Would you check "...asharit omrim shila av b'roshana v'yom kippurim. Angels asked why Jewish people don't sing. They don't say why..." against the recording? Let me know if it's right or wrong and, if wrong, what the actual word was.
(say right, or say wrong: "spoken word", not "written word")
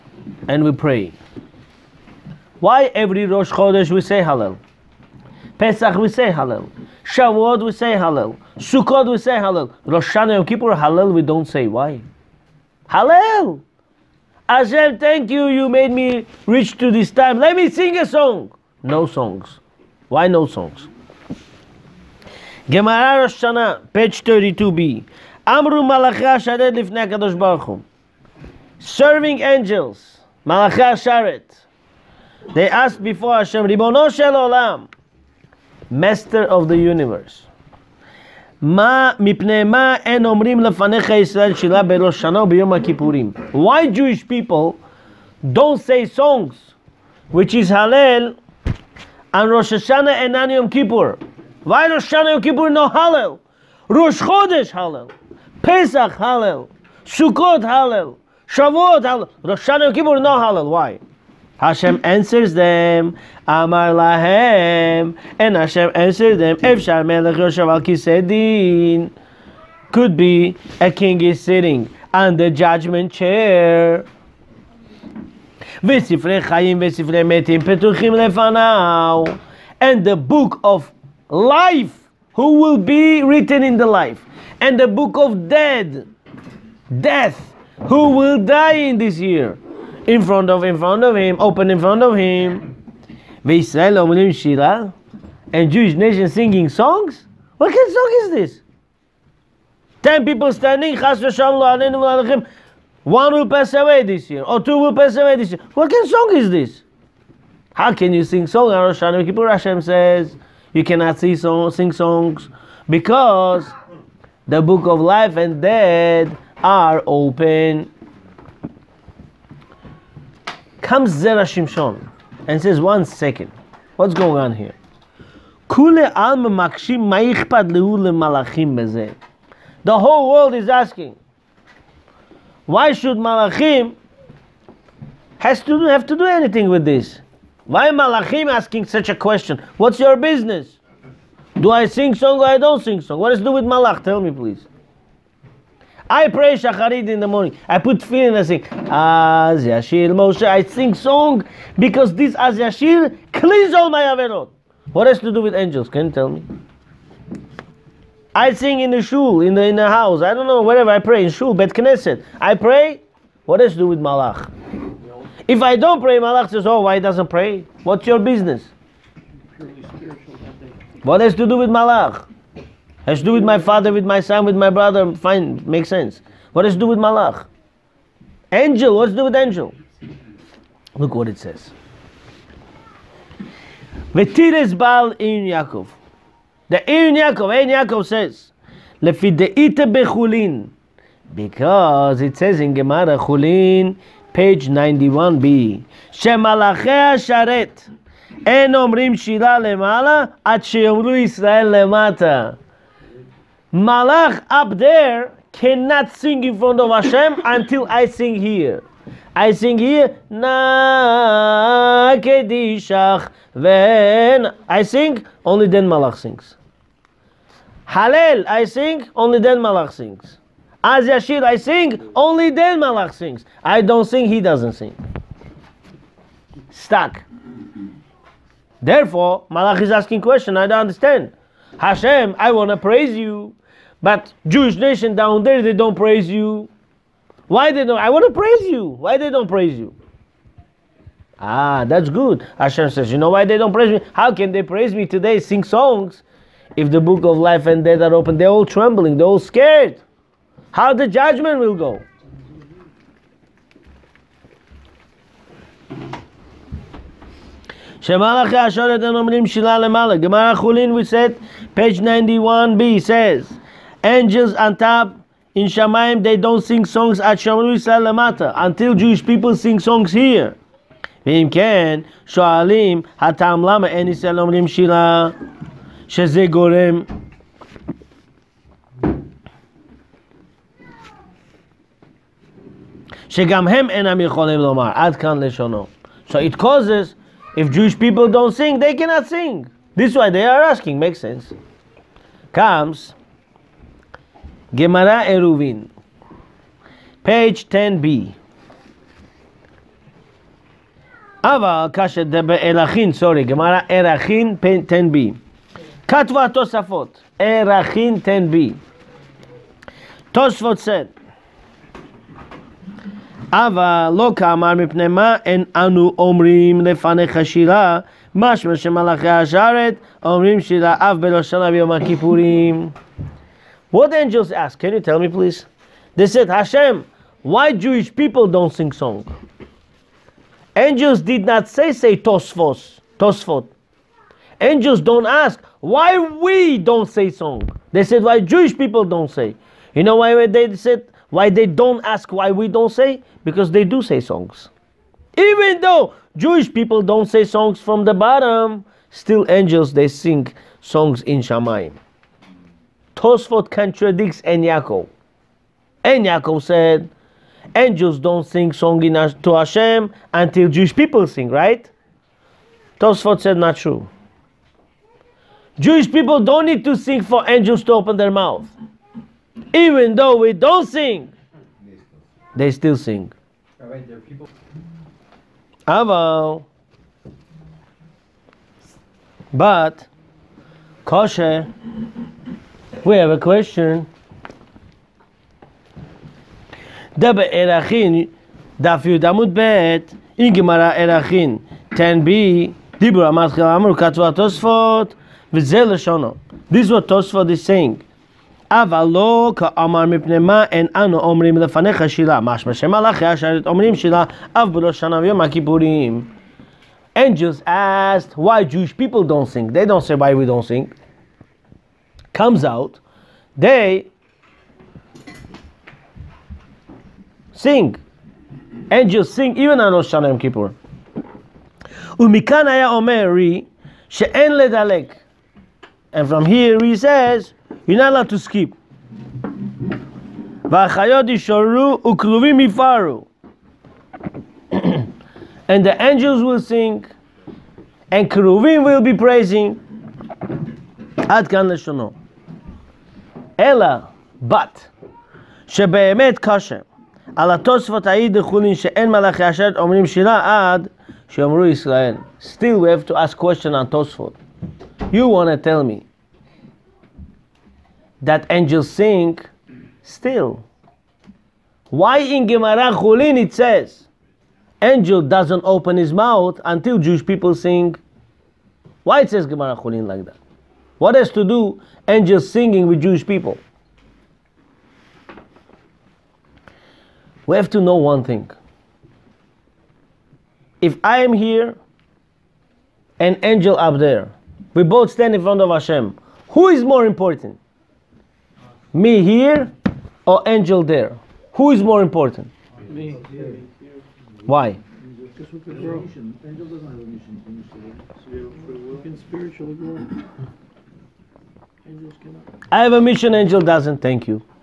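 right.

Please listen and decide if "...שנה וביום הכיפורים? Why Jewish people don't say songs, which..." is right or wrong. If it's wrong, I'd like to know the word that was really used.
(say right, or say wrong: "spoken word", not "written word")
right.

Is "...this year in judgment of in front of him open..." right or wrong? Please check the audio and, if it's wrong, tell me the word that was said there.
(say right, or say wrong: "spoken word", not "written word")
wrong: "front", not "judgment".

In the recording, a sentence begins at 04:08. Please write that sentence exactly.
They're all trembling, they're all scared how the judgment will go.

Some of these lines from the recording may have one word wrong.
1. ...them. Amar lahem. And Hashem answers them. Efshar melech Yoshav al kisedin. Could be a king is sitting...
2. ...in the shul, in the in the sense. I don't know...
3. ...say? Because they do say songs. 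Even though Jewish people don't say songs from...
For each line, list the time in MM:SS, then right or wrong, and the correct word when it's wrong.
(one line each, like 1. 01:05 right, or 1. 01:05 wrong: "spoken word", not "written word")
1. 01:02 right
2. 02:38 wrong: "house", not "sense"
3. 05:42 right.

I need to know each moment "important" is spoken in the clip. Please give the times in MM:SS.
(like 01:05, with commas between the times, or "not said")
08:07, 08:12.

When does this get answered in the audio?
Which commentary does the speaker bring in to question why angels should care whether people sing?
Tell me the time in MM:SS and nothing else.
02:01.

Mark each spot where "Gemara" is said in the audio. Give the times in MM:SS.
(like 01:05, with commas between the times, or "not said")
00:22, 03:12, 04:20, 04:54, 06:30, 07:42, 07:49.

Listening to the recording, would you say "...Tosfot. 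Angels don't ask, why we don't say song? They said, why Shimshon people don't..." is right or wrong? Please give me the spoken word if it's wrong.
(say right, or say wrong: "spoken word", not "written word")
wrong: "Jewish", not "Shimshon".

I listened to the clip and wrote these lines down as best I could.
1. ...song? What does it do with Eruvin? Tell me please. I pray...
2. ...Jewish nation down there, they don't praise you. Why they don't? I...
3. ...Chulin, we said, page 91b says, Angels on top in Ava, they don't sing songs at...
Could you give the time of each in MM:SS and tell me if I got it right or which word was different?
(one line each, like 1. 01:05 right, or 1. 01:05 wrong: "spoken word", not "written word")
1. 02:23 wrong: "Malach", not "Eruvin"
2. 03:54 right
3. 04:20 wrong: "Shamaim", not "Ava".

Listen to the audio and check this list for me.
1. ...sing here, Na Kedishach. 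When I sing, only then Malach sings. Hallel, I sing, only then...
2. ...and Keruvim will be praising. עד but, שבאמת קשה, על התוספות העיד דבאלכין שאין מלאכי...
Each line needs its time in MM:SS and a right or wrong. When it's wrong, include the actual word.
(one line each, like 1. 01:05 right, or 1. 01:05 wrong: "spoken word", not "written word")
1. 03:29 right
2. 07:18 wrong: "דחולין", not "דבאלכין".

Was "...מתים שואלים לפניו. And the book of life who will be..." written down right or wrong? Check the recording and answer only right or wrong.
wrong.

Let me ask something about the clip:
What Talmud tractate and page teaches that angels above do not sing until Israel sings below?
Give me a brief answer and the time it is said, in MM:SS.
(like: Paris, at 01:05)
Chulin 91b, at 03:13.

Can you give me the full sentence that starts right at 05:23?
What the angels ask, can you tell me please?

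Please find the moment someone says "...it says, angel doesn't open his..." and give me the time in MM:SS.
07:43.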